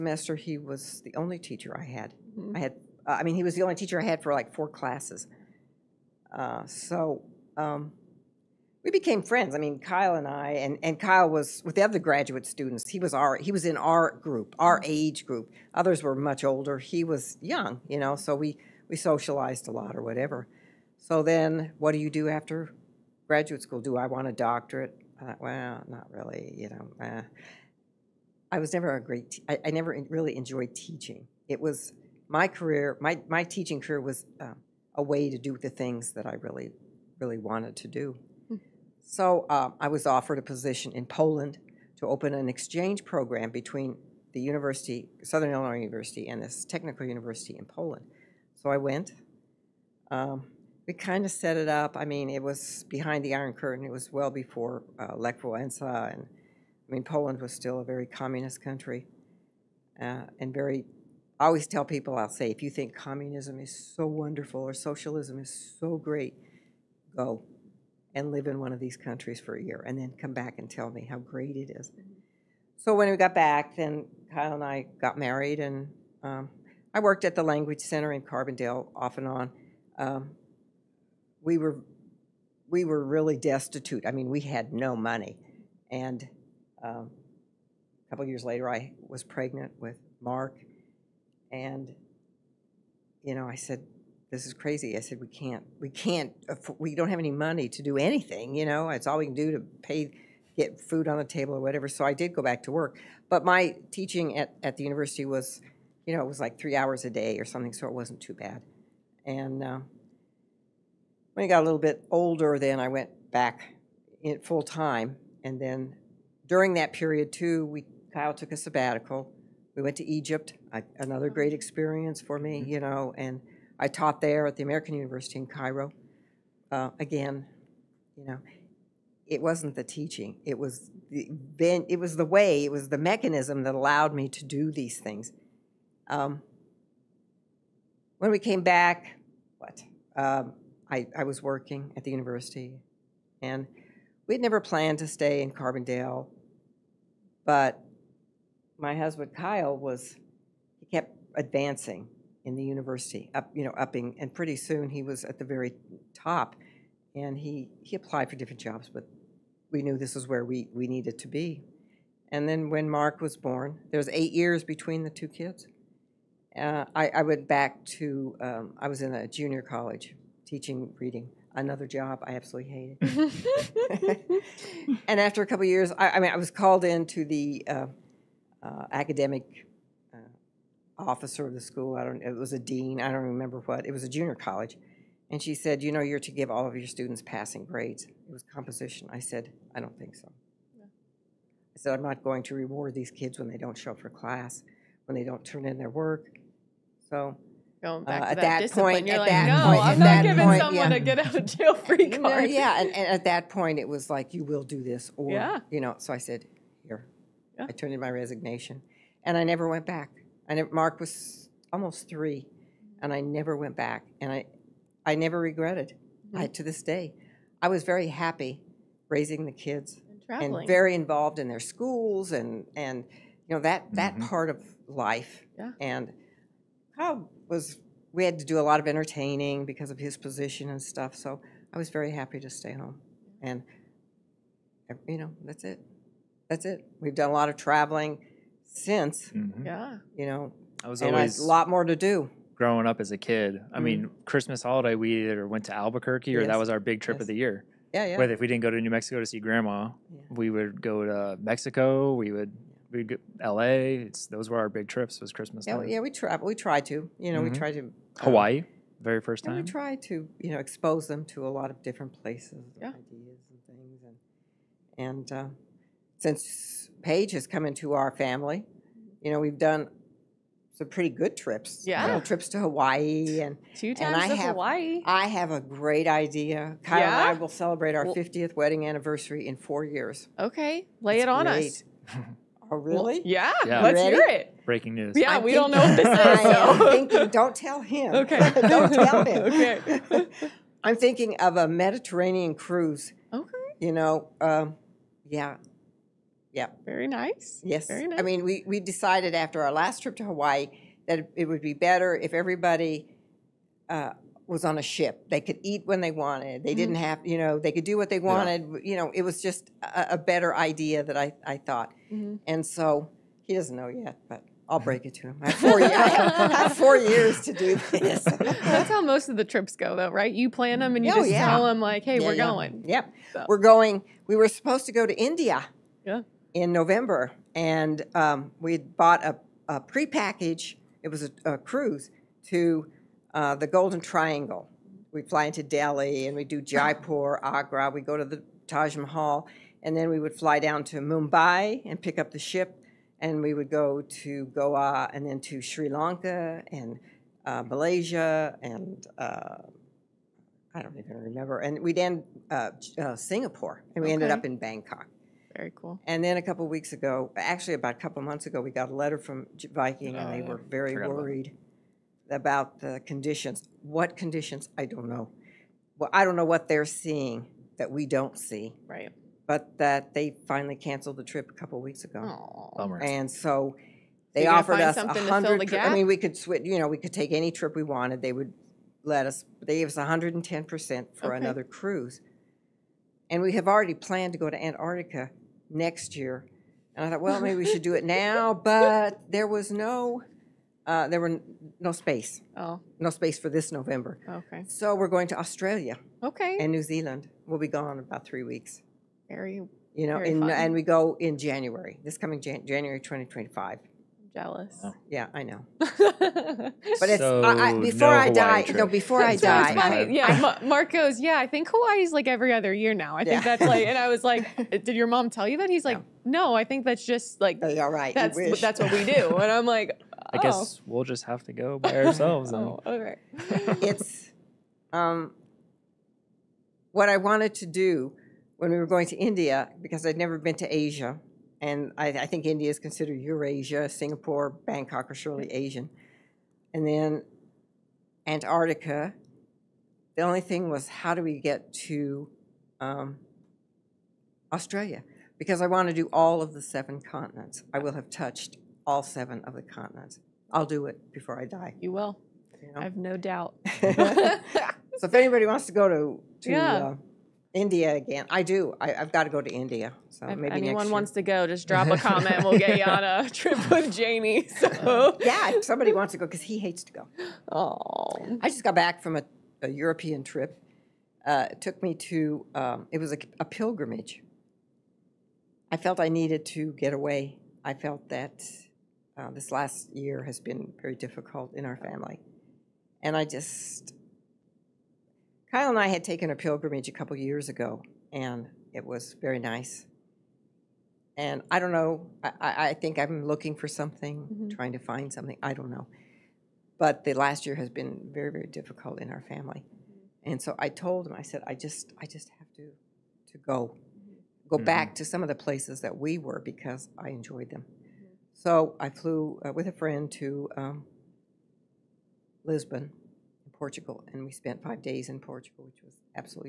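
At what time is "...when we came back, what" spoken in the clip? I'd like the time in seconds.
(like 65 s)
138 s.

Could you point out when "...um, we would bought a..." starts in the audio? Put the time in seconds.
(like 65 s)
328 s.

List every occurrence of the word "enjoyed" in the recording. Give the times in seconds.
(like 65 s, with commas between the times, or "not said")
30 s, 507 s.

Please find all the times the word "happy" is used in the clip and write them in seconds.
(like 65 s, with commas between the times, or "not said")
218 s, 232 s.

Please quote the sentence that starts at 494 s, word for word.
trying to find something, I don't know.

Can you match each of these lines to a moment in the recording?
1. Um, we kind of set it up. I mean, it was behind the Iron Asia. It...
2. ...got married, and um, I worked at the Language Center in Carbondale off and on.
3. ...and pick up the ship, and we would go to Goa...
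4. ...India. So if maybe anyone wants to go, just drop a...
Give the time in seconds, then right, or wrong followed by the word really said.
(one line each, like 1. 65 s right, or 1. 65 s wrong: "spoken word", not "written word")
1. 50 s wrong: "Curtain", not "Asia"
2. 75 s right
3. 341 s right
4. 459 s right.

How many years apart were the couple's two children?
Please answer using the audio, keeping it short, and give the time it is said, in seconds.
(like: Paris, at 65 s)
8, at 164 s.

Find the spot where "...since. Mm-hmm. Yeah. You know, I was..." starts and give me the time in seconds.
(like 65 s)
238 s.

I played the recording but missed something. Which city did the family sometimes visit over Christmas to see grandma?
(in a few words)
Albuquerque.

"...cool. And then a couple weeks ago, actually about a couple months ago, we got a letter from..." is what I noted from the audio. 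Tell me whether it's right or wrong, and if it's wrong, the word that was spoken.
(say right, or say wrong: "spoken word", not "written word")
right.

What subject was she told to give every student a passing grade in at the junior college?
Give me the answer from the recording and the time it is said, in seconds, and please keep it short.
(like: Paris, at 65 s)
Composition, at 188 s.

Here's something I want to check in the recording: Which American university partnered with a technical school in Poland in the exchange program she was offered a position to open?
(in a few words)
Southern Illinois University.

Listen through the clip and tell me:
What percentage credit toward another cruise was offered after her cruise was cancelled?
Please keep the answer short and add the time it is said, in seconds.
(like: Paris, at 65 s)
110%, at 379 s.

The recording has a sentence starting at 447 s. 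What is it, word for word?
I will have touched all seven of the continents.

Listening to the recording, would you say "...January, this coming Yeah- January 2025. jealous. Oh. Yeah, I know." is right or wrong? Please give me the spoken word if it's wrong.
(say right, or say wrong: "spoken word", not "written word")
wrong: "Jan", not "Yeah".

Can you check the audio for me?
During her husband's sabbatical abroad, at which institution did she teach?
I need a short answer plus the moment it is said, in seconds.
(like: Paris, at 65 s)
American University in Cairo, at 124 s.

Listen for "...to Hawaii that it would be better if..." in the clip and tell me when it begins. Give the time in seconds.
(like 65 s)
300 s.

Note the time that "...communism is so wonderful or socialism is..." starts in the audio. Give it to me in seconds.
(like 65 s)
62 s.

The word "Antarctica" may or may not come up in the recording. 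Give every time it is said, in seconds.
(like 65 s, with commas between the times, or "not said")
384 s, 438 s.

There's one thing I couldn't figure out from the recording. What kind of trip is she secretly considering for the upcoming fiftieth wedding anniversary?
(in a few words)
Mediterranean cruise.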